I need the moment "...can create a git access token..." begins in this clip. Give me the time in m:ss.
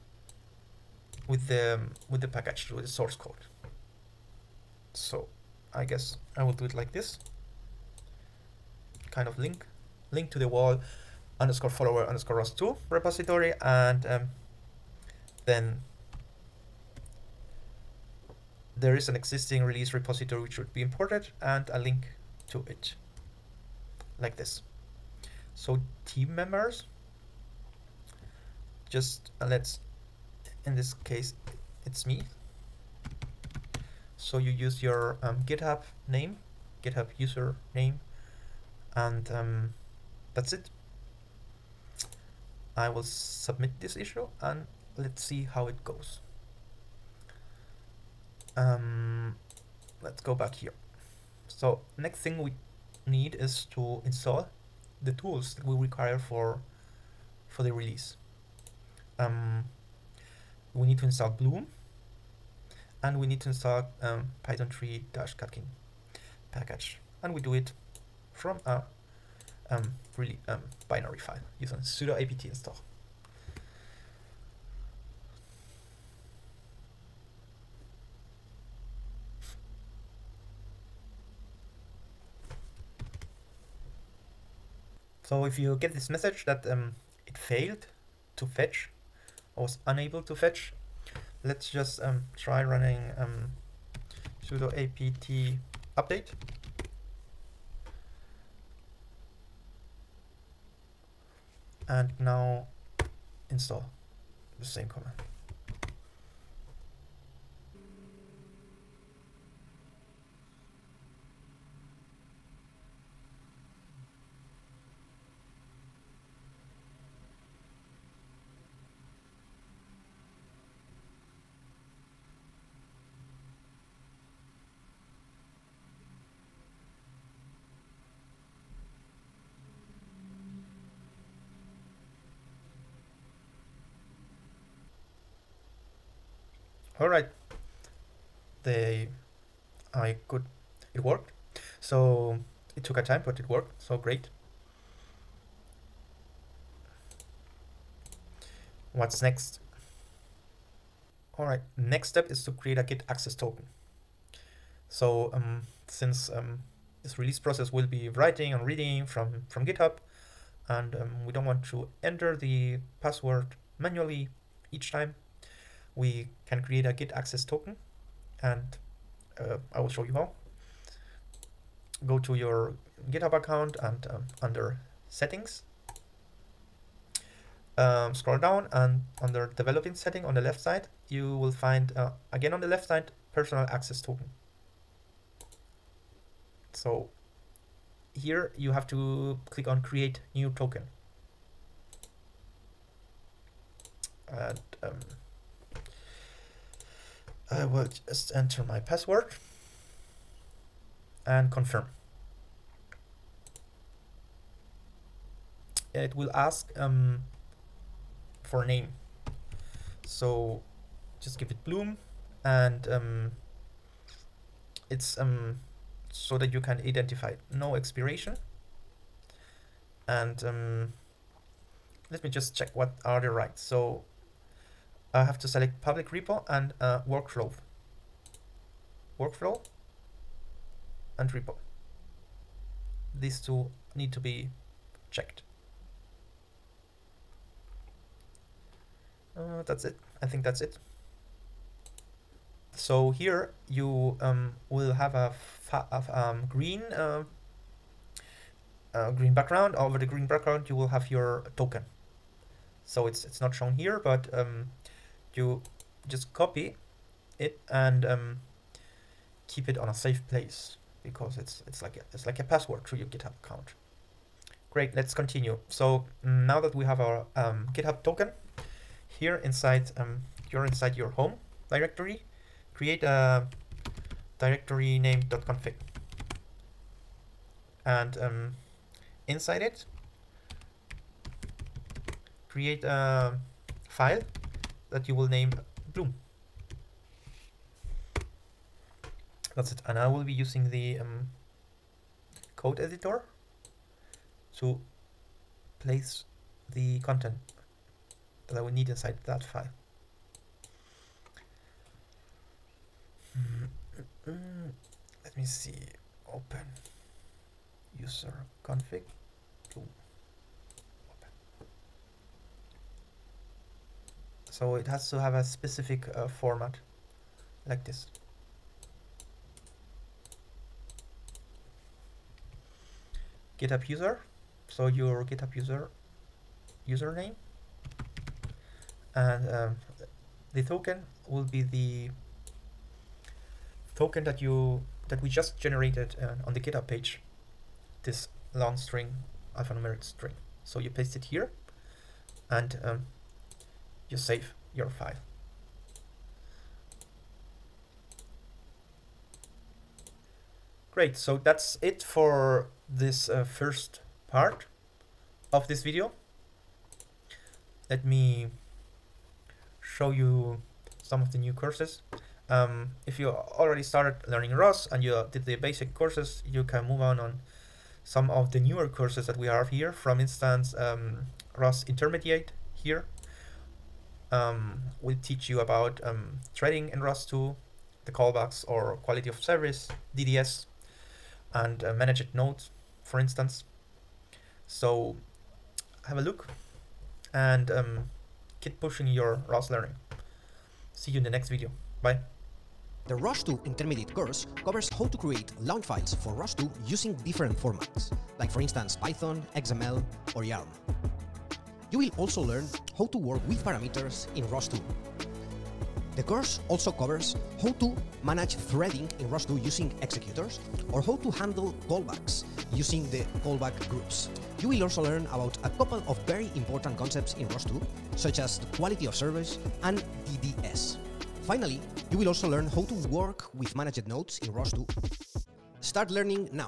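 2:46.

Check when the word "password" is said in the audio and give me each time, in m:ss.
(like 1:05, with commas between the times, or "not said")
2:42, 3:18, 4:22.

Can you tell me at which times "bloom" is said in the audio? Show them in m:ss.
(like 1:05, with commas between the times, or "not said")
1:01, 3:31, 4:45, 5:09.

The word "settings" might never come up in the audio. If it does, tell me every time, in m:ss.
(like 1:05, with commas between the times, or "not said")
2:55, 2:59.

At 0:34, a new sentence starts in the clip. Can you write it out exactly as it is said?
So you use your um, GitHub name, GitHub user name, and um, that's it.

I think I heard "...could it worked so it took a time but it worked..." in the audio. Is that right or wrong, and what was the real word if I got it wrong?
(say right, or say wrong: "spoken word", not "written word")
right.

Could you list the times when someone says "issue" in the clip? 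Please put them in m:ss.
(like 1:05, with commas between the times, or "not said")
0:43.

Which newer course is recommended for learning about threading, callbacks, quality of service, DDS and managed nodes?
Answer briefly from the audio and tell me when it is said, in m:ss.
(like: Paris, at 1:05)
ROS Intermediate, at 6:11.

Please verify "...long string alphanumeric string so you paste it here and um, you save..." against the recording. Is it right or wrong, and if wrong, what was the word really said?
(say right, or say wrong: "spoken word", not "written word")
right.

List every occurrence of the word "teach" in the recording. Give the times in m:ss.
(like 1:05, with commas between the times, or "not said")
6:15.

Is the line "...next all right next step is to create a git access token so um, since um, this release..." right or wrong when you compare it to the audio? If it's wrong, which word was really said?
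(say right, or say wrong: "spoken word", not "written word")
right.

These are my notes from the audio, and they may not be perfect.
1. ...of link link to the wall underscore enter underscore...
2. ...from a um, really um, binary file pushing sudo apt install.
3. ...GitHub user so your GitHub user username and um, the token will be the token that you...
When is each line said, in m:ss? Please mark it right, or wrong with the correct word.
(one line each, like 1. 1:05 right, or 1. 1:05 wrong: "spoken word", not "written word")
1. 0:09 wrong: "follower", not "enter"
2. 1:08 wrong: "using", not "pushing"
3. 5:23 right.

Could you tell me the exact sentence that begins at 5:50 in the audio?
Great, so that's it for this uh, first part of this video.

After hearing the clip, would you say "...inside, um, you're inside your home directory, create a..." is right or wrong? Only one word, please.
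right.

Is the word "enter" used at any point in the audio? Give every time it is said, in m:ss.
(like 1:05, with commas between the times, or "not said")
2:42, 3:18.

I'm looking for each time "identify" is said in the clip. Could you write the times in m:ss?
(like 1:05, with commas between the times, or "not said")
3:36.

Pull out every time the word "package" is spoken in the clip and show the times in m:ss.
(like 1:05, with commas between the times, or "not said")
0:02, 1:06.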